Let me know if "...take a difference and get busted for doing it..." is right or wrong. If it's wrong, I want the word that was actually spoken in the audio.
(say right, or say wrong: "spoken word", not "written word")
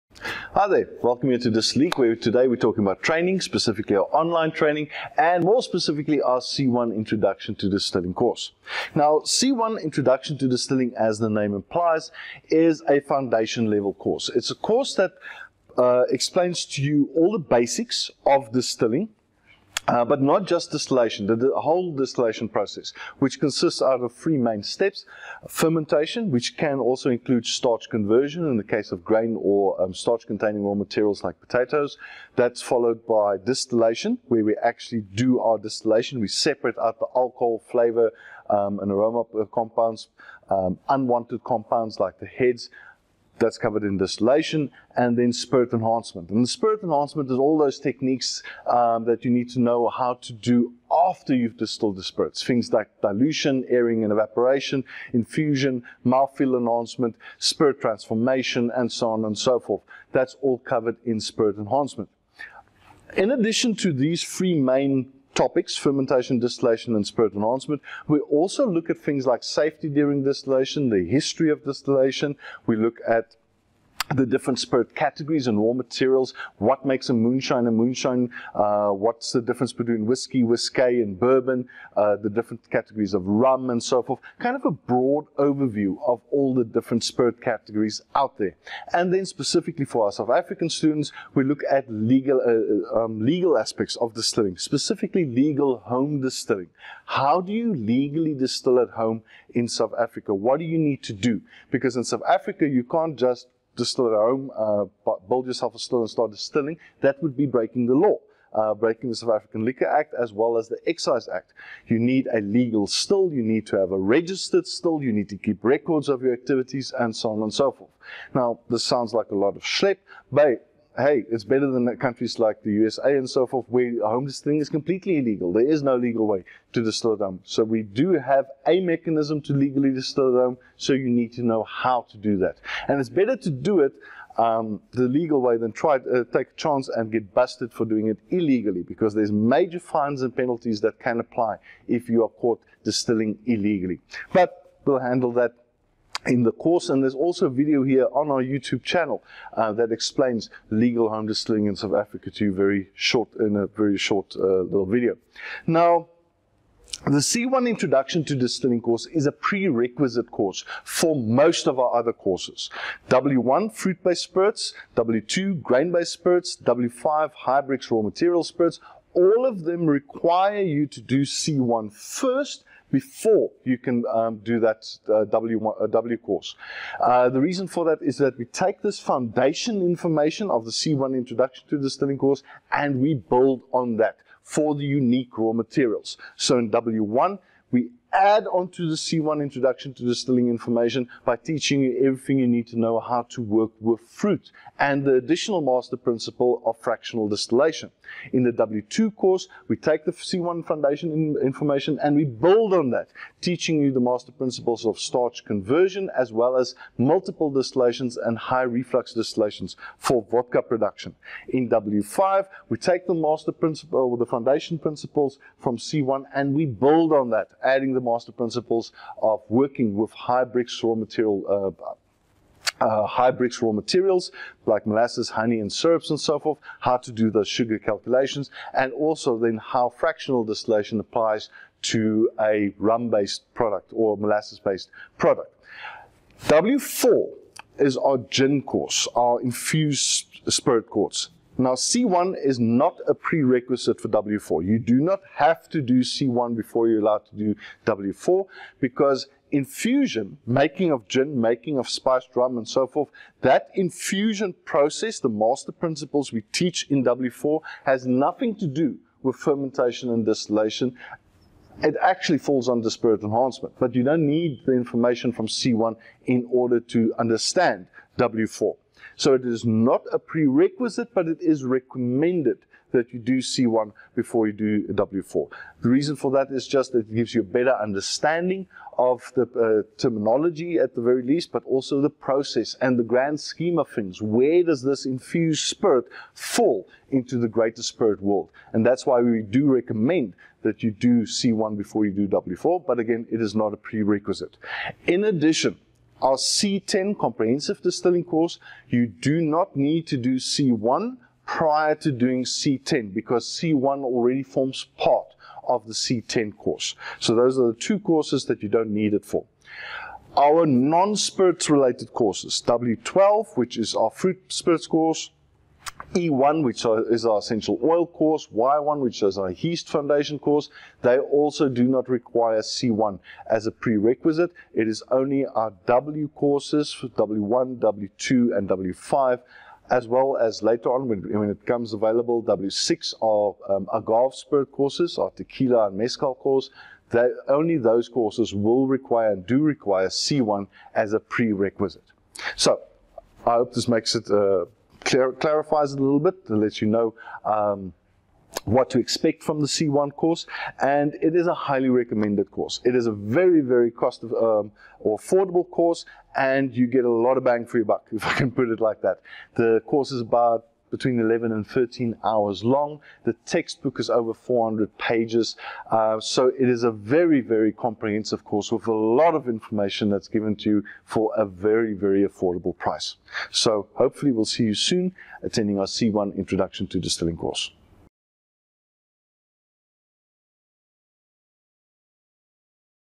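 wrong: "chance", not "difference".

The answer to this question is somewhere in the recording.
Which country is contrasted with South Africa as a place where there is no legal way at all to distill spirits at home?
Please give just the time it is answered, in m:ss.
2:02.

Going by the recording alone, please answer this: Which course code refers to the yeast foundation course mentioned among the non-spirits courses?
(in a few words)
Y1.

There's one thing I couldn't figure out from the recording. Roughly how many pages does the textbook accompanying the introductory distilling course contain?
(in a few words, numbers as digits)
over 400.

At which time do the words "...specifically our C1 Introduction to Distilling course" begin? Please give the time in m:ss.
0:05.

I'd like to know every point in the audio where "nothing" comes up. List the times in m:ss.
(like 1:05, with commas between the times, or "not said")
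4:18.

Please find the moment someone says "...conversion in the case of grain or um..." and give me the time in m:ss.
0:27.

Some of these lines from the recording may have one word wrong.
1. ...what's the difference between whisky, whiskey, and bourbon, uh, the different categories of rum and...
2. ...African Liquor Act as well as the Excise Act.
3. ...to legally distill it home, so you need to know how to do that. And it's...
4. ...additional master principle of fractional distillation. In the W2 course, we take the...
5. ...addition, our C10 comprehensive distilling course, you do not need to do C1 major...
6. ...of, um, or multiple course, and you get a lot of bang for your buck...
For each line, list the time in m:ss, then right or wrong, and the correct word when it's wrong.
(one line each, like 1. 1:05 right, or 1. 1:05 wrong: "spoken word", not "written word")
1. 1:18 right
2. 1:49 right
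3. 2:09 right
4. 3:15 right
5. 4:55 wrong: "prior", not "major"
6. 5:54 wrong: "affordable", not "multiple".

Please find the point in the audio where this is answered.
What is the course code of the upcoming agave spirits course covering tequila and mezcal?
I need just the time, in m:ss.
5:32.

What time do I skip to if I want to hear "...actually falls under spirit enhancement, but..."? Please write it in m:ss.
4:22.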